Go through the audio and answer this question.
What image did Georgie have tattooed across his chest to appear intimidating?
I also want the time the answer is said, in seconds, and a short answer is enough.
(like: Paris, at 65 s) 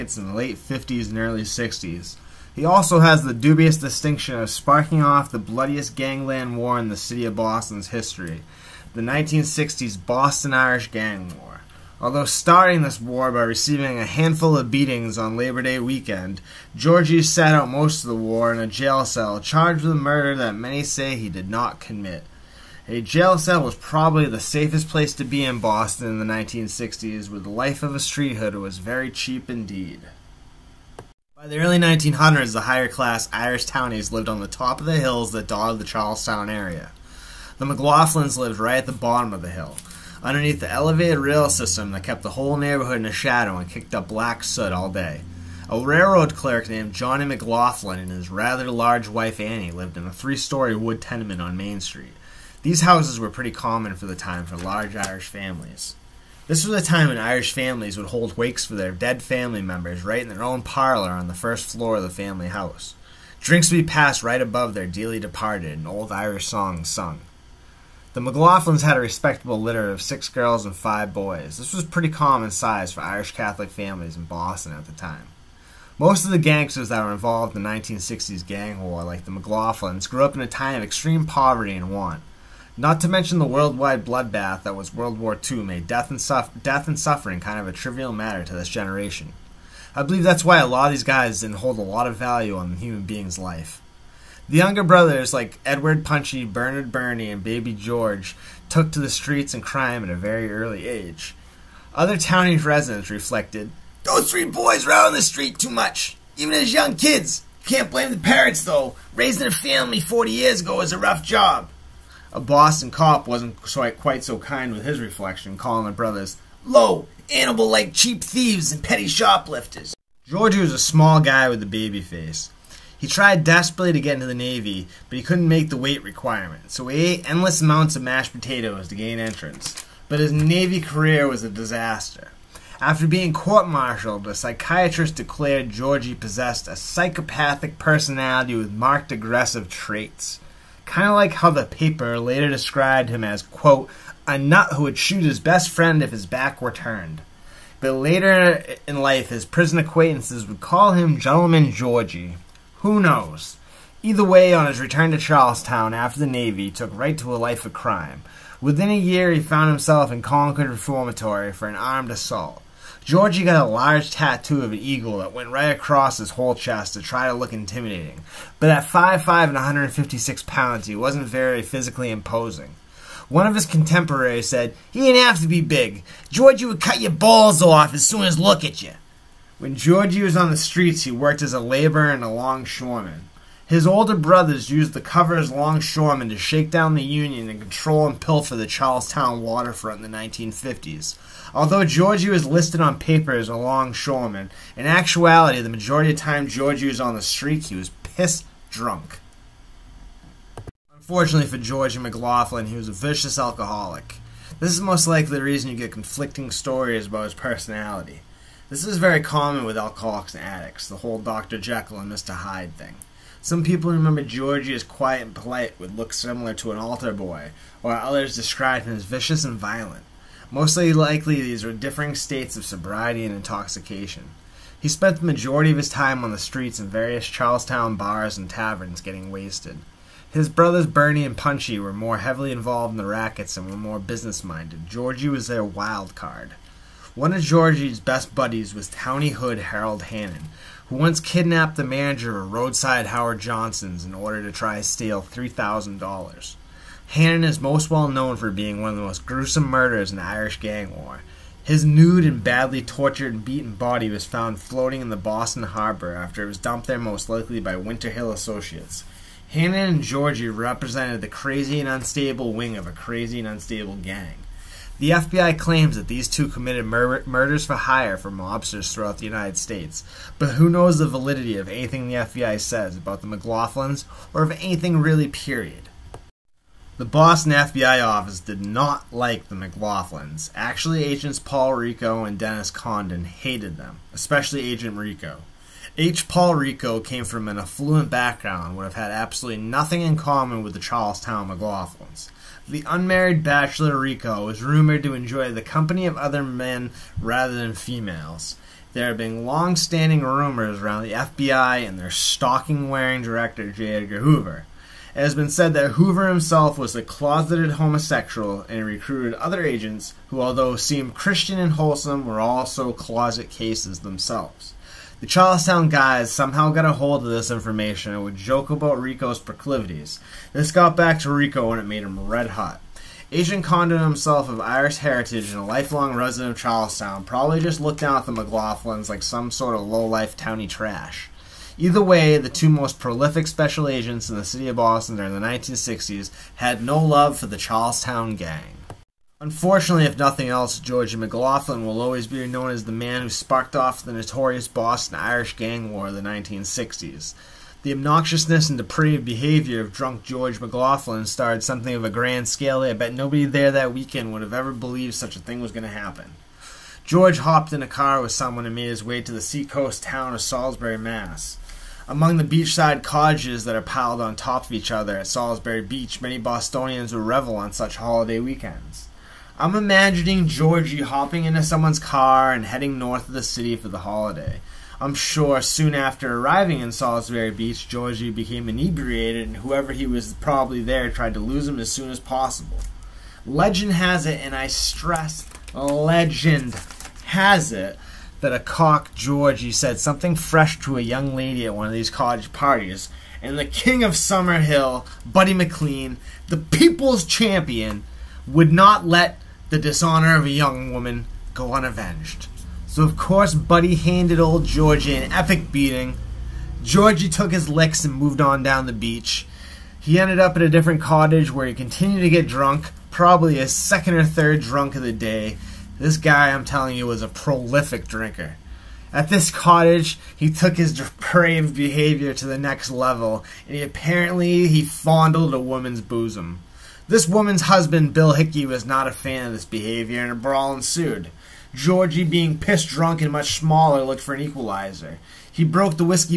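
An eagle, at 164 s.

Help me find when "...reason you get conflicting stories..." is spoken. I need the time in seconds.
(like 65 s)
205 s.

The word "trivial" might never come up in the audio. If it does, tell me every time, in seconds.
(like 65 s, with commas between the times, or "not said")
87 s.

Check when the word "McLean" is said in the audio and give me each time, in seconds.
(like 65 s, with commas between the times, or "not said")
395 s.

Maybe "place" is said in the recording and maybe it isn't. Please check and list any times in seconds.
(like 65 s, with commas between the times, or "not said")
24 s.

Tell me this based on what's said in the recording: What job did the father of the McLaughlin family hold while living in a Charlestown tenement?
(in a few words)
Railroad clerk.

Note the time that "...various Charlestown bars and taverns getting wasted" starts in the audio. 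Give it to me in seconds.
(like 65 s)
226 s.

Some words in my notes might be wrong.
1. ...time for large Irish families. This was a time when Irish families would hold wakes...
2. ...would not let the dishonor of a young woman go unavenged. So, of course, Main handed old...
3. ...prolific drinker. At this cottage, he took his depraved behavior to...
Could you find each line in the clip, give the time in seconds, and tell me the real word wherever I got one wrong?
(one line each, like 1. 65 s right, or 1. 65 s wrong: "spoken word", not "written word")
1. 54 s right
2. 398 s wrong: "Buddy", not "Main"
3. 417 s right.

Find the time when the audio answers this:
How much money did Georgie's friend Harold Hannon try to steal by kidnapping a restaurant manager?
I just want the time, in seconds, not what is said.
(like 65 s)
245 s.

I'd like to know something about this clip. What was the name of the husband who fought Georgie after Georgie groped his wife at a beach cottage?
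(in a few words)
Bill Hickey.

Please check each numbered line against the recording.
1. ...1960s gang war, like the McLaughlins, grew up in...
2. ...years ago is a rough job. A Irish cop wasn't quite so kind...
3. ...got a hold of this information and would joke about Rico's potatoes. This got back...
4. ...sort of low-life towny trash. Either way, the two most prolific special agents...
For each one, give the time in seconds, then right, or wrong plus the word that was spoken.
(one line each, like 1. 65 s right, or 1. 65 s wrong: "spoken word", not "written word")
1. 77 s right
2. 110 s wrong: "Boston", not "Irish"
3. 316 s wrong: "proclivities", not "potatoes"
4. 329 s right.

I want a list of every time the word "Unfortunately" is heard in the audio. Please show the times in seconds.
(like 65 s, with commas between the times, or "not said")
200 s, 339 s.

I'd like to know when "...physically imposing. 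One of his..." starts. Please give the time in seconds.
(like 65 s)
171 s.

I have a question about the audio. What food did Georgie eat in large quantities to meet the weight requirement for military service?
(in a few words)
Mashed potatoes.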